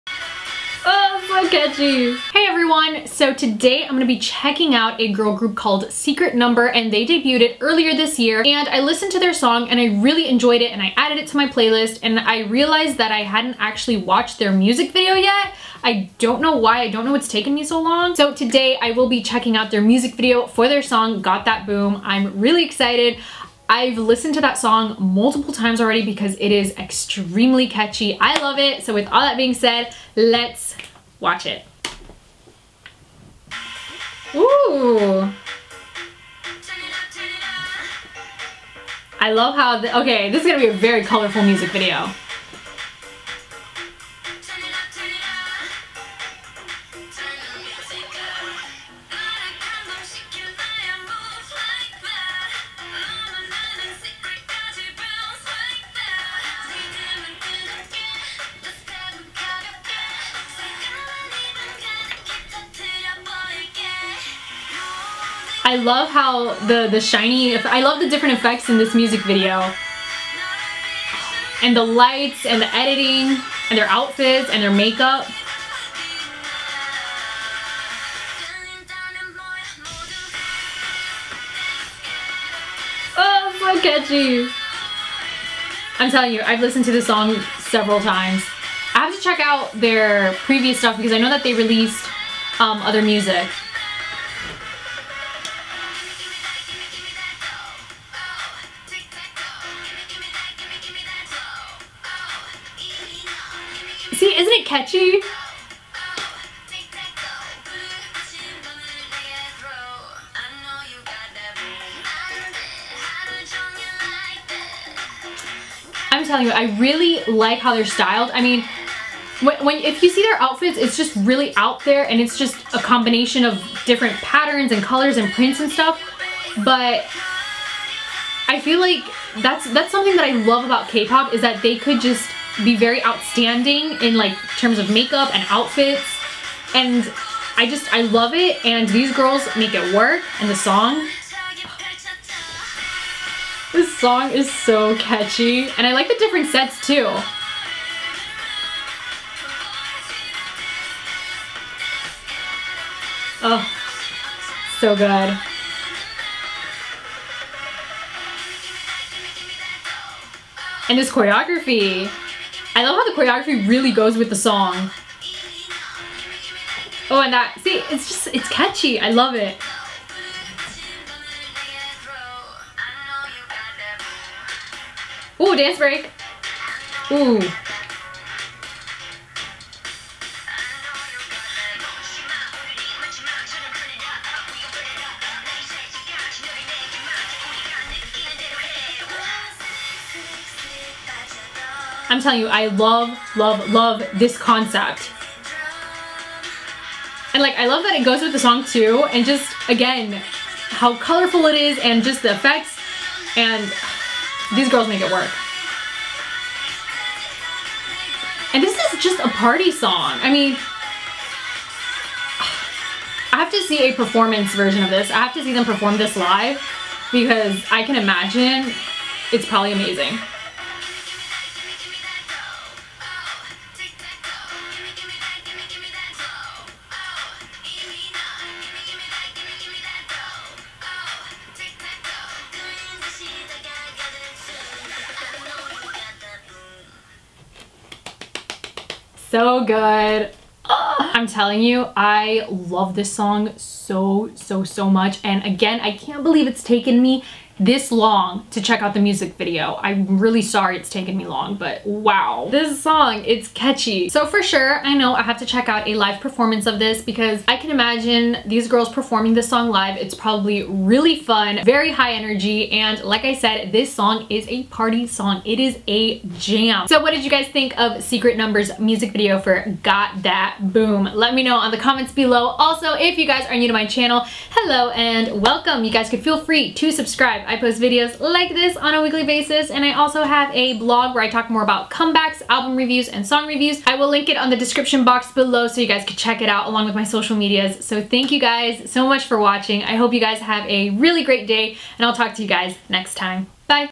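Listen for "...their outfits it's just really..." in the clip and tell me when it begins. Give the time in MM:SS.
02:00.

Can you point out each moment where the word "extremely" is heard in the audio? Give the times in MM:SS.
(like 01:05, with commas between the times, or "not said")
00:26.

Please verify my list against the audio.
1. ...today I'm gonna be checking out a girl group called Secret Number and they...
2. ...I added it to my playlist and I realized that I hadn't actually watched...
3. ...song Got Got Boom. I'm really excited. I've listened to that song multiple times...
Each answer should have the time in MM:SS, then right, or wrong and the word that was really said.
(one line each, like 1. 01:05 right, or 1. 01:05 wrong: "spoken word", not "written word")
1. 00:03 right
2. 00:10 right
3. 00:20 wrong: "That", not "Got".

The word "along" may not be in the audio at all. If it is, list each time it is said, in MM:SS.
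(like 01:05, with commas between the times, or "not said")
04:46.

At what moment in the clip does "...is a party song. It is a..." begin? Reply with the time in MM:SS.
04:24.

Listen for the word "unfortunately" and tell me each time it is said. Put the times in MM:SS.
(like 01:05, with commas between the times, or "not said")
not said.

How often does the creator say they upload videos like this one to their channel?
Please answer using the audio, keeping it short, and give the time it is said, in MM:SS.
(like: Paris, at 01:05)
Weekly, at 04:39.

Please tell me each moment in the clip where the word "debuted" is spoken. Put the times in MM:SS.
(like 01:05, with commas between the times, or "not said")
00:07.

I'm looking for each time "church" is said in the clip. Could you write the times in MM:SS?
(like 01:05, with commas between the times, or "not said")
not said.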